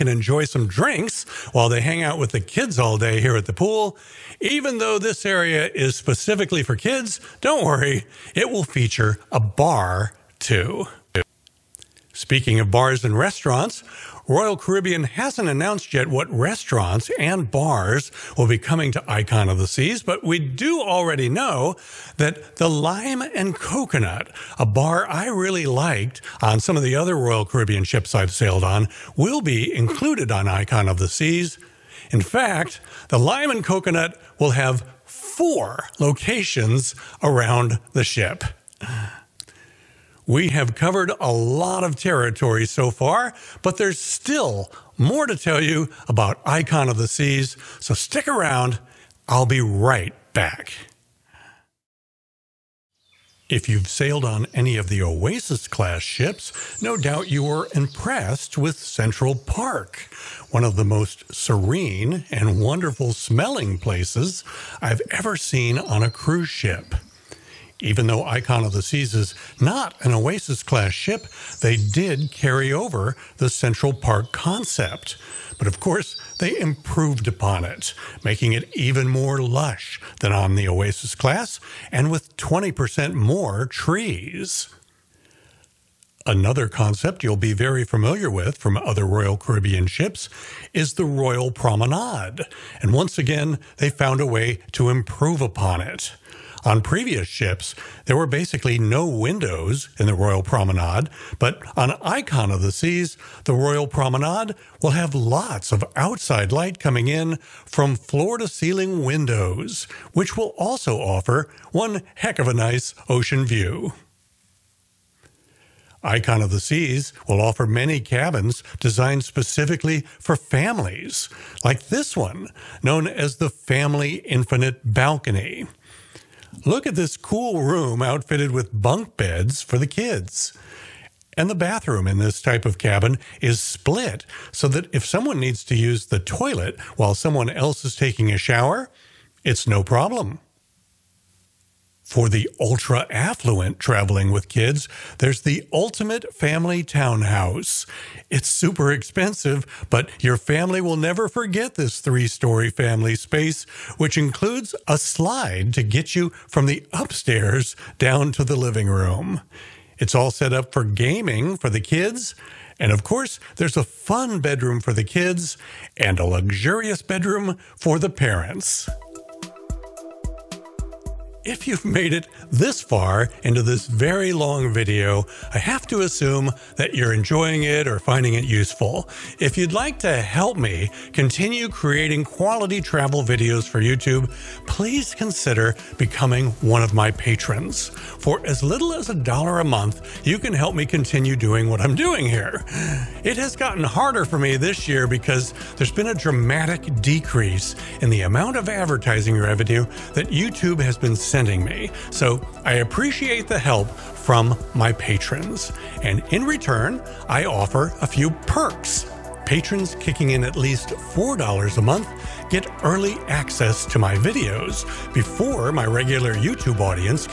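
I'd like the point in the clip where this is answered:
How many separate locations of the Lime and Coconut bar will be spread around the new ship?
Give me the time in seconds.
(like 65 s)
35 s.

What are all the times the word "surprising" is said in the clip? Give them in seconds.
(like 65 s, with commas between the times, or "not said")
not said.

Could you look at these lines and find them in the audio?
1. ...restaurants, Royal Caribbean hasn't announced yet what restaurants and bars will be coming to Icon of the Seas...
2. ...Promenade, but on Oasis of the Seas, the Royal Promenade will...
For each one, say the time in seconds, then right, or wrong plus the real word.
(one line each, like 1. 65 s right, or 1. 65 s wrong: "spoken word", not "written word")
1. 13 s right
2. 100 s wrong: "Icon", not "Oasis".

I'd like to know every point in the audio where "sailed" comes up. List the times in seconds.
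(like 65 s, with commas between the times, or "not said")
28 s, 53 s.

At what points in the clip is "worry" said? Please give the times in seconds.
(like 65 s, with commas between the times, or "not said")
7 s.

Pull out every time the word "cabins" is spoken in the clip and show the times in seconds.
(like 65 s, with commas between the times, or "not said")
117 s, 132 s.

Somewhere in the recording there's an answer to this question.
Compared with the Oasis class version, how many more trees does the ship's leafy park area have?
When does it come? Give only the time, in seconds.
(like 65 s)
82 s.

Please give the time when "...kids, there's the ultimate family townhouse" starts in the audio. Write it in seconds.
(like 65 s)
144 s.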